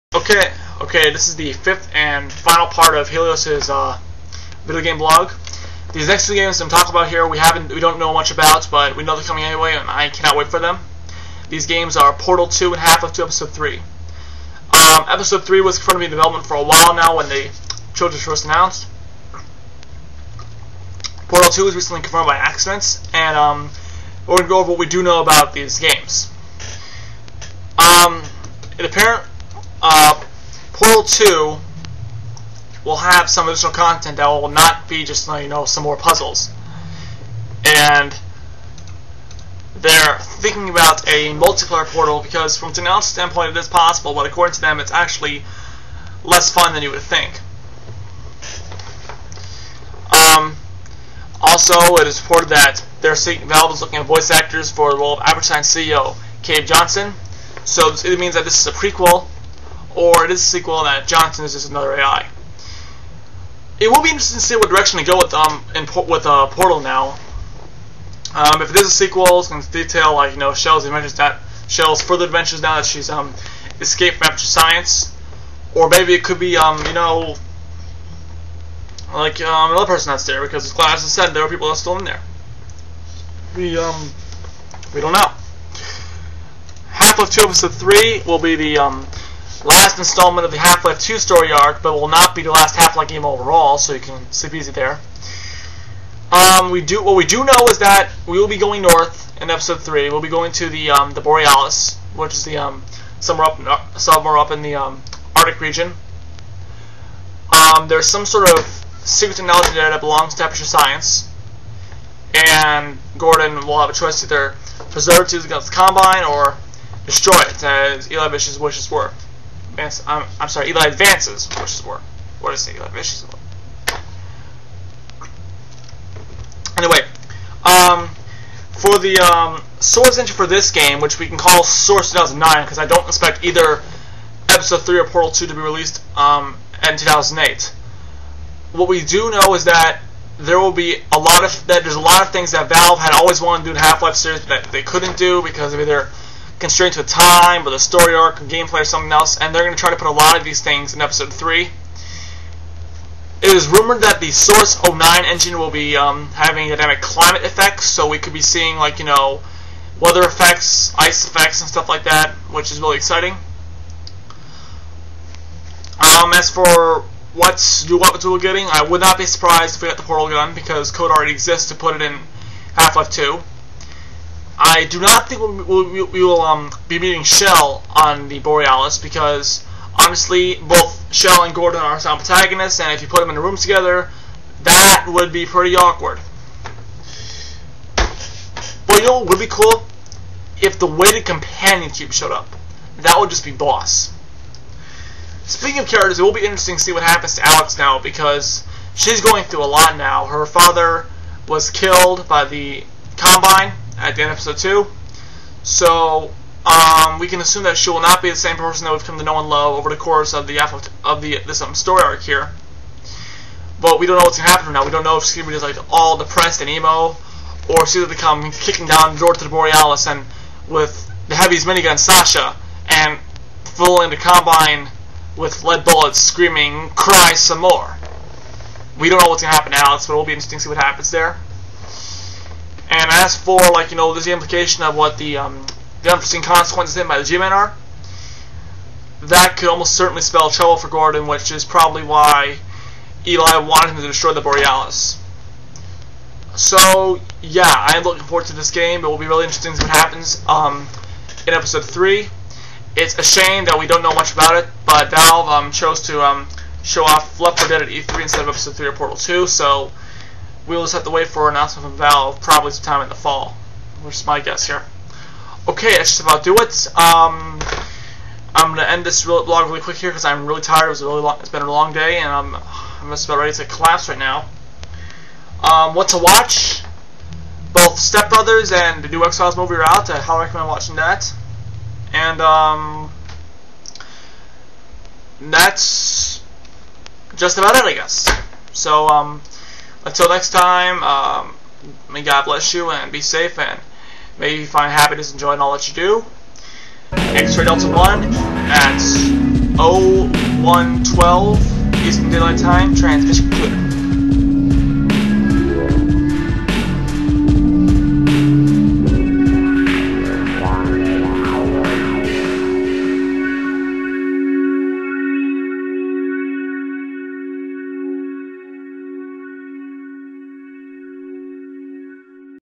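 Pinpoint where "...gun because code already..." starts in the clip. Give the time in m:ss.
2:50.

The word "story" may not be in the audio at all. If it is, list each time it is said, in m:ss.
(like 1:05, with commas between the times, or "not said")
1:31, 2:27, 3:31.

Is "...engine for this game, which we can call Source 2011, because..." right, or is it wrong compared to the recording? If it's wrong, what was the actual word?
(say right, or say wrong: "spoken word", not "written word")
wrong: "2009", not "2011".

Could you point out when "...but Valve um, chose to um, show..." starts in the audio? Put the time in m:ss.
4:14.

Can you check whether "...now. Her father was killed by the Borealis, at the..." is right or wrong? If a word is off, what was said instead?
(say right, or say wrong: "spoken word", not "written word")
wrong: "Combine", not "Borealis".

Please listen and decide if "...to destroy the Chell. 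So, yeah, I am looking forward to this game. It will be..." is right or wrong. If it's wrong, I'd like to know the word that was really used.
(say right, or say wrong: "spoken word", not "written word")
wrong: "Borealis", not "Chell".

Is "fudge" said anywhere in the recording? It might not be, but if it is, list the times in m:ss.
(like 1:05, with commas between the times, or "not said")
not said.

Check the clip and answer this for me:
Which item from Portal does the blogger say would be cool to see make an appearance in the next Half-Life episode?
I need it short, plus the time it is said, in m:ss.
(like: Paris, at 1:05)
Weighted companion cube, at 3:10.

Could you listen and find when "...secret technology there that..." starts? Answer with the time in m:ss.
1:49.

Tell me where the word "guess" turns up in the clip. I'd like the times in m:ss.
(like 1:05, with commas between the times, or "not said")
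4:24, 4:47.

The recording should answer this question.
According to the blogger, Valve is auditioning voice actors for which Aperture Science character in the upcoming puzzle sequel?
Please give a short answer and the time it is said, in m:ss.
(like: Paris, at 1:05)
Cave Johnson, at 0:56.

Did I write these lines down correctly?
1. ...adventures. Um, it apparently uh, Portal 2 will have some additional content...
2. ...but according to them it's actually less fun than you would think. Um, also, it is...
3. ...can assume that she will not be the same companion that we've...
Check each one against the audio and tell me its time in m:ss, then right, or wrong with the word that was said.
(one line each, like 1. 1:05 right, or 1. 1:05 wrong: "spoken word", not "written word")
1. 0:25 wrong: "games", not "adventures"
2. 0:44 right
3. 3:27 wrong: "person", not "companion".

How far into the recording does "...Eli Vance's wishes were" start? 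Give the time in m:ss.
2:00.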